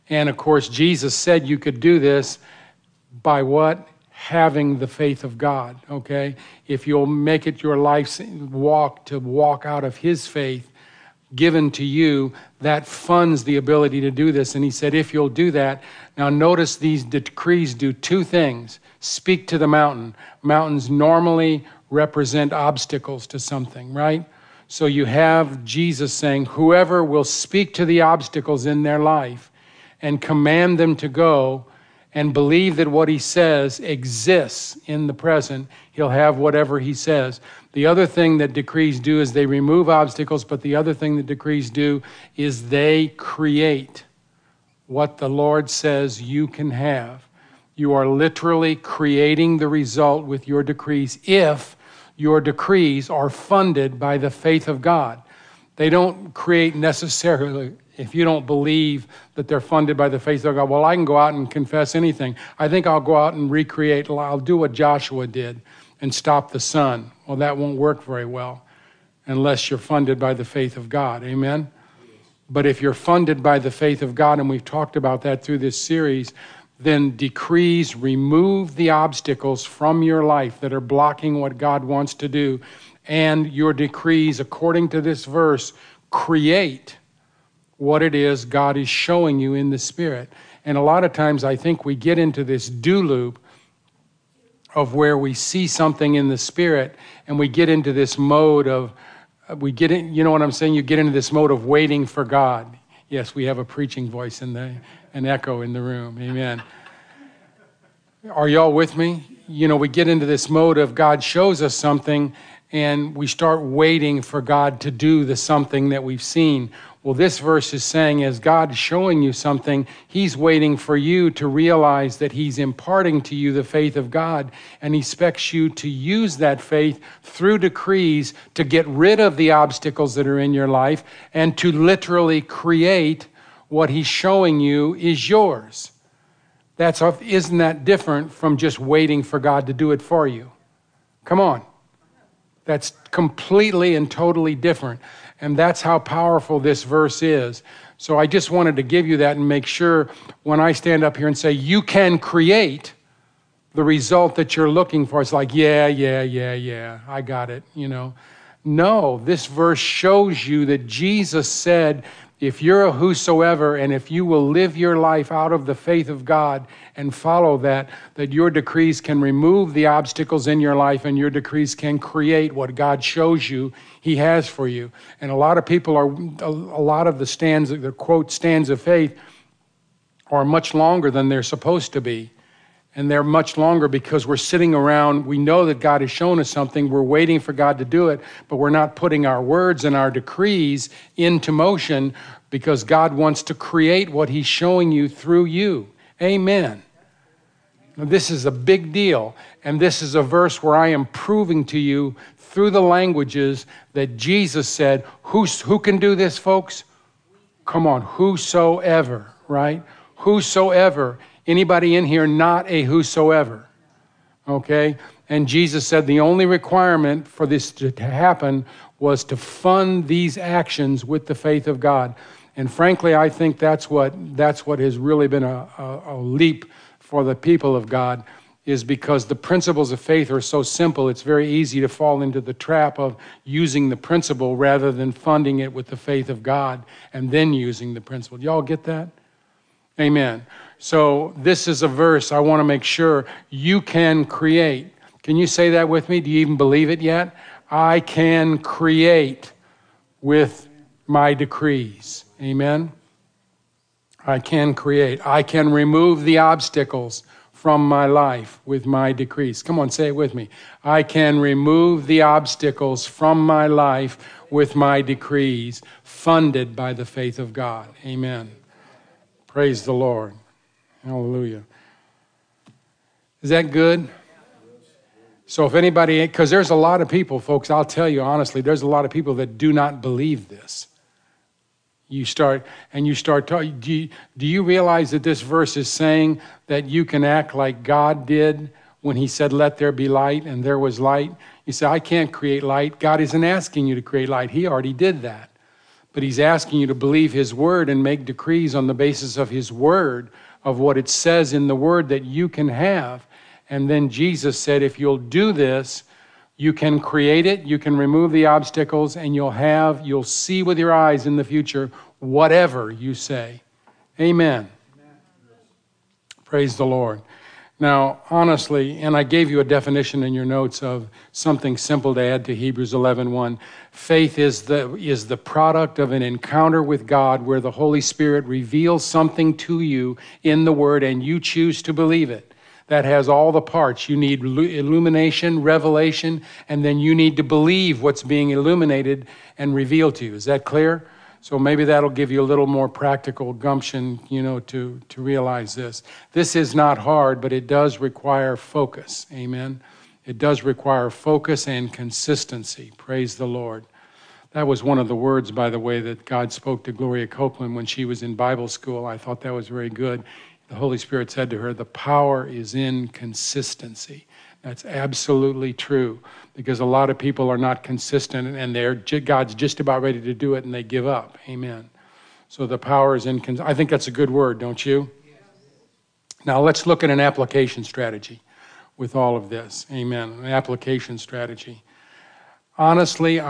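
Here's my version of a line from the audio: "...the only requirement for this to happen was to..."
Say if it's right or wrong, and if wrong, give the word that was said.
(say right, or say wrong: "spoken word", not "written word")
right.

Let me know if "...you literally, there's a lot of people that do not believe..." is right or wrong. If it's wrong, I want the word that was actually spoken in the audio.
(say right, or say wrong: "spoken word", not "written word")
wrong: "honestly", not "literally".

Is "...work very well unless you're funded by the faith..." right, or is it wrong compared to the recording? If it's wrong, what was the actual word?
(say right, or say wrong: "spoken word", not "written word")
right.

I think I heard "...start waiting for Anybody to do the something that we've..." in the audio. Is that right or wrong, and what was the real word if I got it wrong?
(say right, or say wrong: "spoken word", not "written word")
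wrong: "God", not "Anybody".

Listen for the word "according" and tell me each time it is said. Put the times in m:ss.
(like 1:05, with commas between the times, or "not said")
1:24.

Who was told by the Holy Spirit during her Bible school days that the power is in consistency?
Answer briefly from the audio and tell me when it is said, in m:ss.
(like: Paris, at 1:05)
Gloria Copeland, at 5:56.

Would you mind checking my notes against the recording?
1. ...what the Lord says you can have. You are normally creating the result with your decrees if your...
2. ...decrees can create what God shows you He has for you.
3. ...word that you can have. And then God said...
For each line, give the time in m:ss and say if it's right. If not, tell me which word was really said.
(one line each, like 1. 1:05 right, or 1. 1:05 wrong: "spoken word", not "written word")
1. 0:44 wrong: "literally", not "normally"
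2. 2:51 right
3. 5:01 wrong: "Jesus", not "God".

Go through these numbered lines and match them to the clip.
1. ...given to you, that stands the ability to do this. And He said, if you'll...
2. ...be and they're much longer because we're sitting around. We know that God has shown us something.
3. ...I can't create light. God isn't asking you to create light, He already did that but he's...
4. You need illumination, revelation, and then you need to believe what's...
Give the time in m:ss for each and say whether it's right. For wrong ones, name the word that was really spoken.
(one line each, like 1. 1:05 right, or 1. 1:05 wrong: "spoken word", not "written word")
1. 0:11 wrong: "funds", not "stands"
2. 3:02 right
3. 4:51 right
4. 5:34 right.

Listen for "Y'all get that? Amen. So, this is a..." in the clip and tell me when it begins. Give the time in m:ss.
3:58.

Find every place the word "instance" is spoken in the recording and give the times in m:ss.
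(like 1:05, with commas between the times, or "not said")
not said.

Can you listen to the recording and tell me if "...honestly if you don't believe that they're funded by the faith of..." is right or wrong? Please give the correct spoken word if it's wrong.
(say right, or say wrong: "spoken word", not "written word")
wrong: "necessarily", not "honestly".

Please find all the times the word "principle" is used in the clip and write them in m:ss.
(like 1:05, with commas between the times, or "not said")
3:49, 3:53, 3:57.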